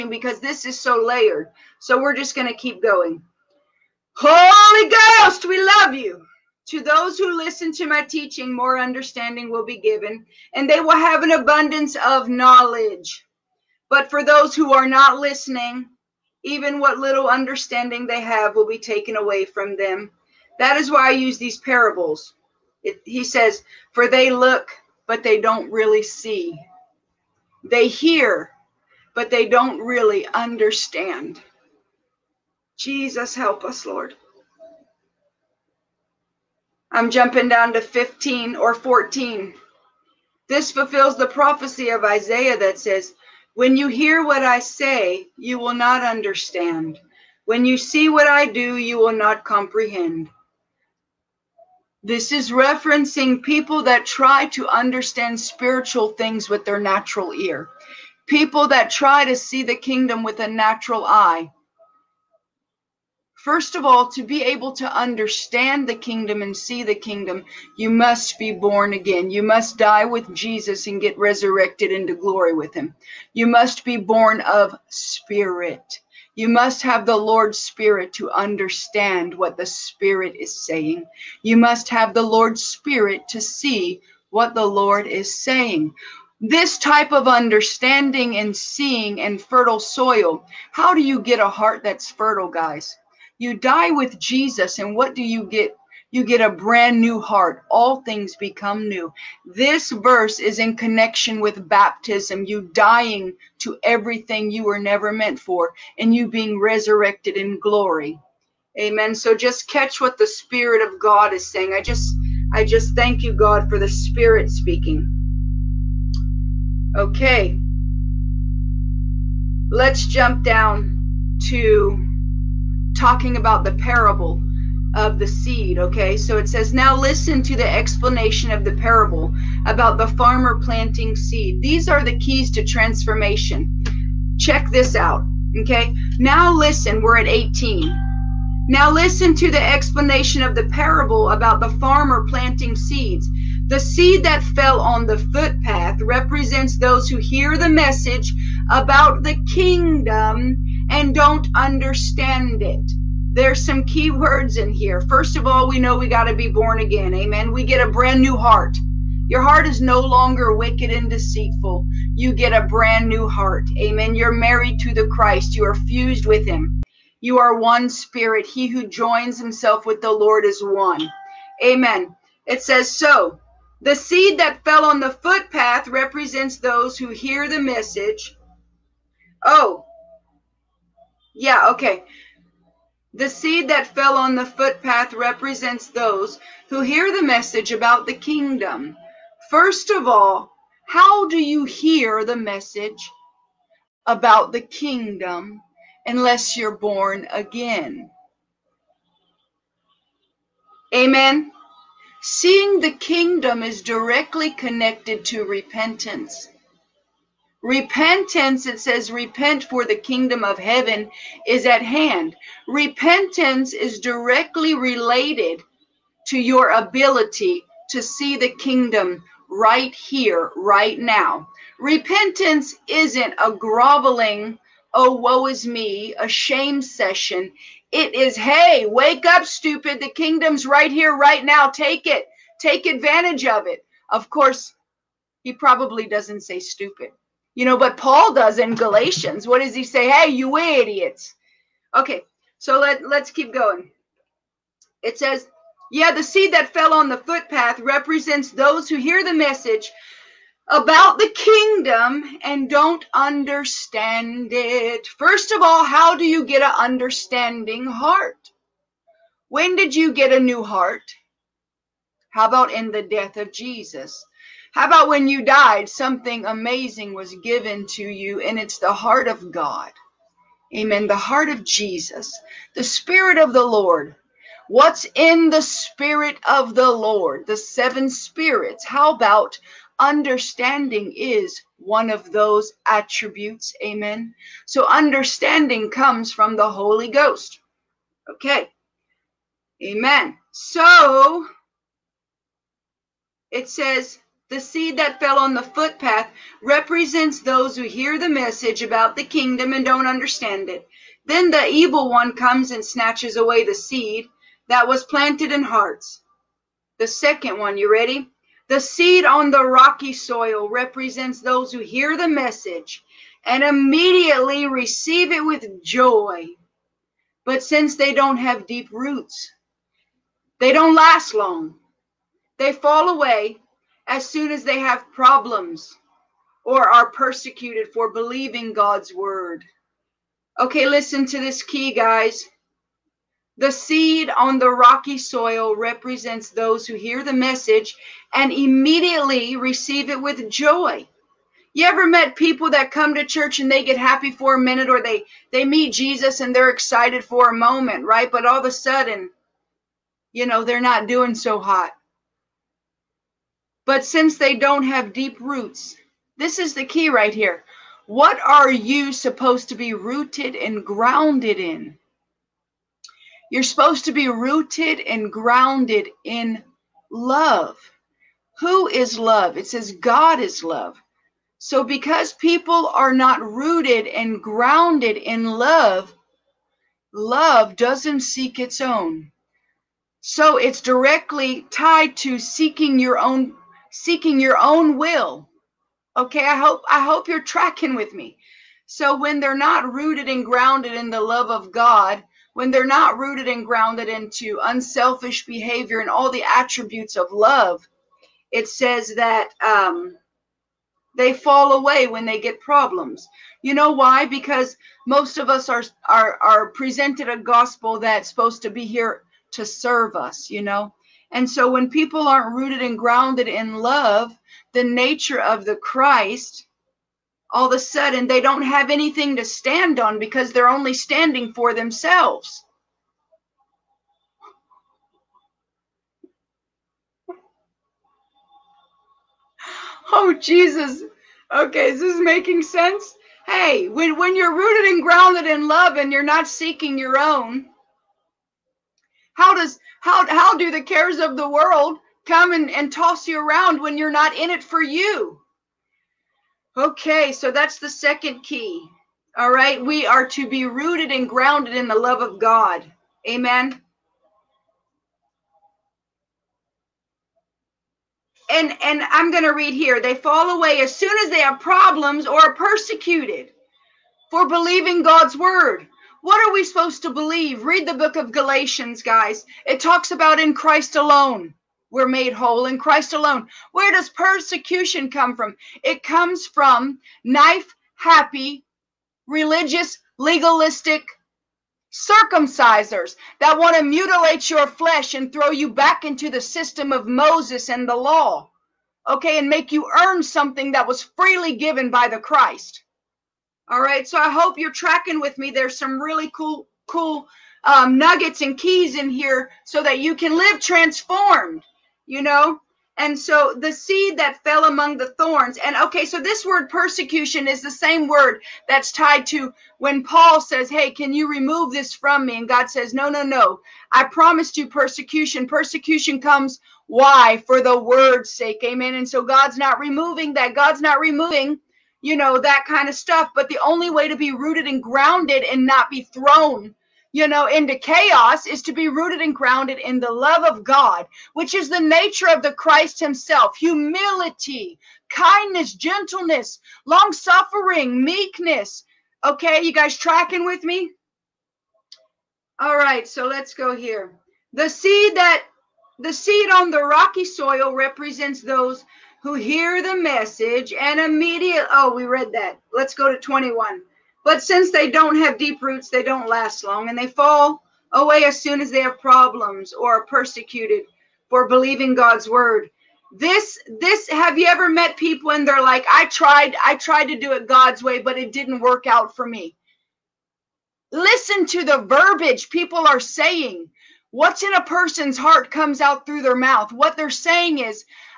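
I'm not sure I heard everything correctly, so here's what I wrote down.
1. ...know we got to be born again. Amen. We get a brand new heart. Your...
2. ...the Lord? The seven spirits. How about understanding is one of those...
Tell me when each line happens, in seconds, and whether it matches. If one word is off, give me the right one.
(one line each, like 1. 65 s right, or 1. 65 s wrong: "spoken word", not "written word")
1. 155 s right
2. 276 s right.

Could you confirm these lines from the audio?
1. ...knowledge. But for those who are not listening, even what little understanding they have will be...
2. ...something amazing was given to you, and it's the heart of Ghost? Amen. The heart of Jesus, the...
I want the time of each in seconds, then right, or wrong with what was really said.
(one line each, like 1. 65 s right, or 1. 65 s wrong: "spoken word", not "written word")
1. 12 s right
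2. 265 s wrong: "God", not "Ghost".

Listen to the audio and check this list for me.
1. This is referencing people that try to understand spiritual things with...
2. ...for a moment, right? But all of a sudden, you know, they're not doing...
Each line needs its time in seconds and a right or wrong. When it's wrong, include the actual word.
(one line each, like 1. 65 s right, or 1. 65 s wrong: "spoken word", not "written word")
1. 52 s right
2. 347 s right.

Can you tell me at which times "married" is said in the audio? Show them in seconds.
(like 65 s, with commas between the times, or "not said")
164 s.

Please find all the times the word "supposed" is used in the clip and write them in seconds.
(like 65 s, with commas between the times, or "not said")
359 s, 363 s, 408 s, 466 s.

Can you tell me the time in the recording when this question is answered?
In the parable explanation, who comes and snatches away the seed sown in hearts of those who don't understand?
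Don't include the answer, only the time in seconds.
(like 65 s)
301 s.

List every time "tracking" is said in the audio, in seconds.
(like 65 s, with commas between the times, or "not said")
387 s, 494 s, 539 s.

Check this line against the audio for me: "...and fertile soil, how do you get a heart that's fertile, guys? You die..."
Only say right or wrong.
right.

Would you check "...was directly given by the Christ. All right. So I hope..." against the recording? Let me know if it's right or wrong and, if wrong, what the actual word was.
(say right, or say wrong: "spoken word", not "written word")
wrong: "freely", not "directly".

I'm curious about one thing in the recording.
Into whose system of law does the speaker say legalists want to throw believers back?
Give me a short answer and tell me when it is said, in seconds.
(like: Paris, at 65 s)
Moses, at 487 s.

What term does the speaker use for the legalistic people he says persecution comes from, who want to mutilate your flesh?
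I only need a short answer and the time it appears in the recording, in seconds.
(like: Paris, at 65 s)
Circumcisers, at 481 s.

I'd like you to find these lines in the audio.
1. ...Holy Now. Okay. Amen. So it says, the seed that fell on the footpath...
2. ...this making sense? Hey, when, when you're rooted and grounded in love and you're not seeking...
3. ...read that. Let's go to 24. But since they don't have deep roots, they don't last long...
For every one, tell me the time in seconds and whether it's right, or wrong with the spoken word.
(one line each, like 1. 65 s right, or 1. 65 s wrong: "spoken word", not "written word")
1. 286 s wrong: "Ghost", not "Now"
2. 431 s right
3. 552 s wrong: "21", not "24".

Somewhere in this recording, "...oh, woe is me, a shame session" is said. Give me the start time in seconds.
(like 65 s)
224 s.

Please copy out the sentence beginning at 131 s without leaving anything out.
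These are the keys to transformation.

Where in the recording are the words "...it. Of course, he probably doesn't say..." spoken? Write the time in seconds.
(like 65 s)
233 s.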